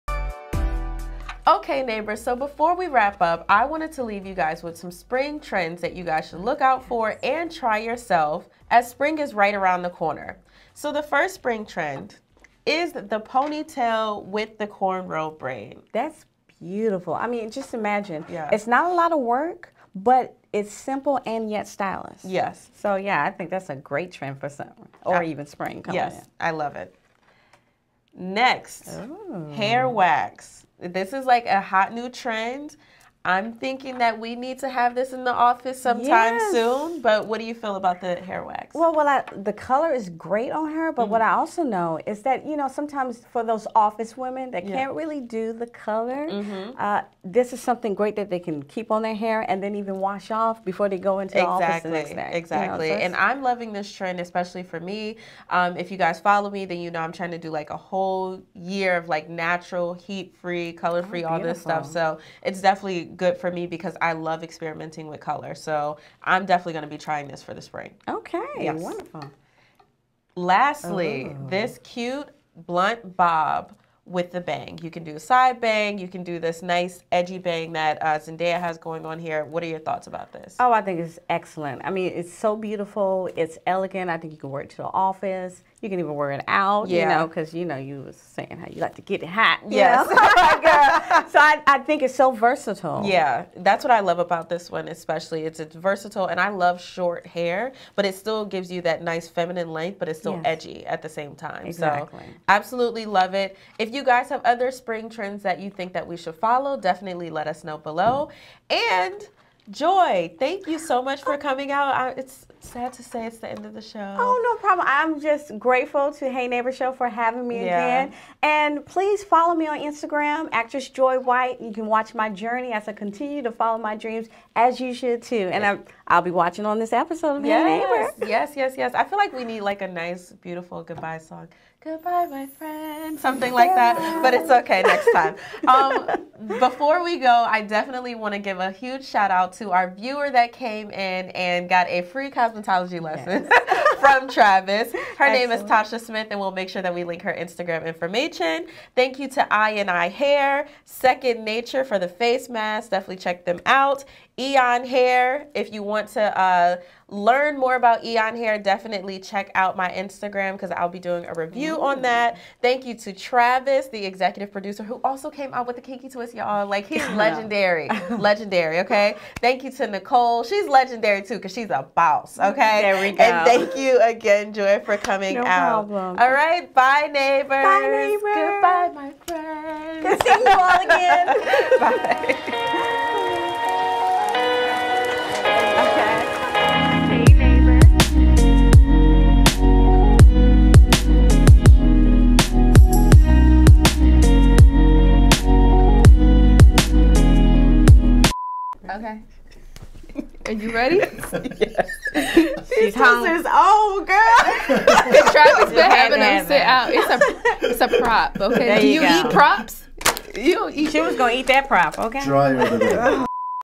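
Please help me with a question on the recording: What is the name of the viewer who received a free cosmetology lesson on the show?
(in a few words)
Tasha Smith.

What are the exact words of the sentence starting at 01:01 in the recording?
So it's definitely good for me because I love experimenting with color.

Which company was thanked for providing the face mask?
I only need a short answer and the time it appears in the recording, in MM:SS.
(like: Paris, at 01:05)
Second Nature, at 02:30.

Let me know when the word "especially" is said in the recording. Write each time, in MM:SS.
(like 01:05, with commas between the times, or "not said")
00:54, 01:34.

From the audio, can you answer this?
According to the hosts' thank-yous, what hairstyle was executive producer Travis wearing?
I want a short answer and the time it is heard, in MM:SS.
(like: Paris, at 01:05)
kinky twist, at 02:45.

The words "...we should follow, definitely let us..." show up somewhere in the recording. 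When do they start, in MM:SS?
01:46.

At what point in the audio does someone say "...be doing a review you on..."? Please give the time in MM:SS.
02:40.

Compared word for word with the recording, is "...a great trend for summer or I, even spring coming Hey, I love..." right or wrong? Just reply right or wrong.
wrong.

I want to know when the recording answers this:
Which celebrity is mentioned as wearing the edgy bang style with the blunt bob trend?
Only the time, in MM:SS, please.
01:18.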